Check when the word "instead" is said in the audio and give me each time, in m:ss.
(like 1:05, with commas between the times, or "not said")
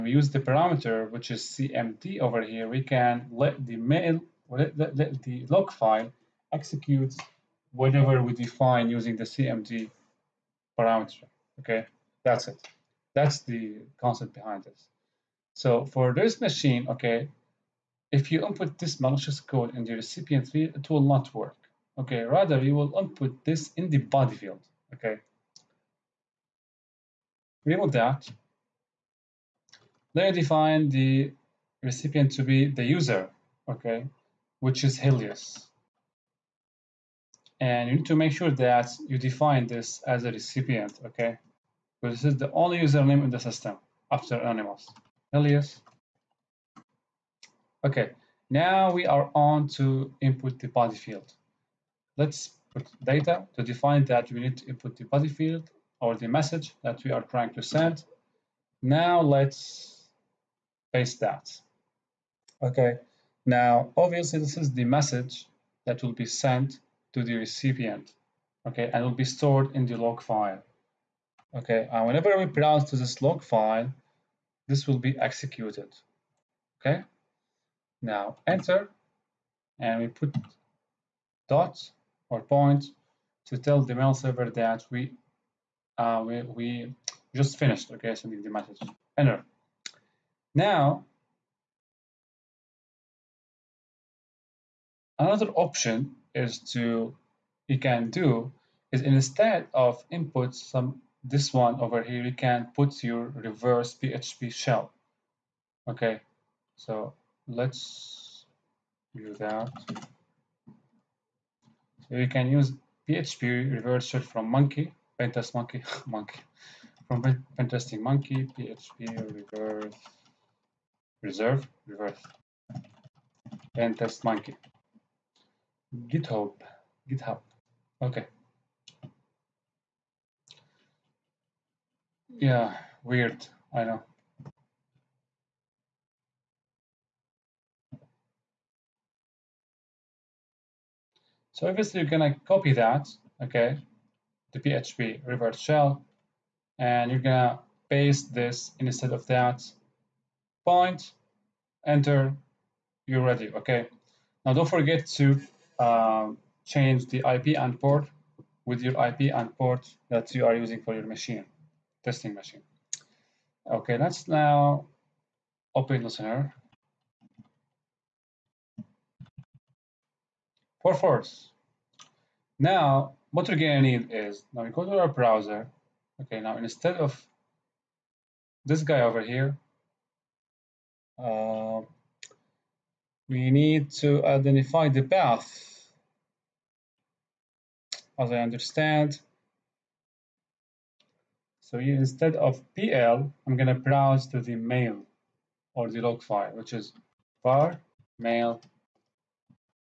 1:39, 2:28, 2:56, 3:11.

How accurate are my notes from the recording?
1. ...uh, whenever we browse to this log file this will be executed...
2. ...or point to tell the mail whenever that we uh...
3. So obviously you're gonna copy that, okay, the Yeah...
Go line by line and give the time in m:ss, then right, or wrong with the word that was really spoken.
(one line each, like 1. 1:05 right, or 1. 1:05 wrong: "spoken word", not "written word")
1. 1:12 right
2. 1:22 wrong: "server", not "whenever"
3. 2:21 wrong: "PHP", not "Yeah".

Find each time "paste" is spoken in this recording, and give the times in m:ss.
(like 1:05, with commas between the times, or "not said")
1:00, 2:27.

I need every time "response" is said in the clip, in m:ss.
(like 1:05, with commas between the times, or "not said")
not said.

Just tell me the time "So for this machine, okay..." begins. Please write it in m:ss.
0:15.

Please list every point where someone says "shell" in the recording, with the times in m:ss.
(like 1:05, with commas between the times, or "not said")
1:44, 1:54, 2:25.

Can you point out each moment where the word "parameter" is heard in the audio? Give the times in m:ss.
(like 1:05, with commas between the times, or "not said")
0:00, 0:10.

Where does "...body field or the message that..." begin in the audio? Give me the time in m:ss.
0:55.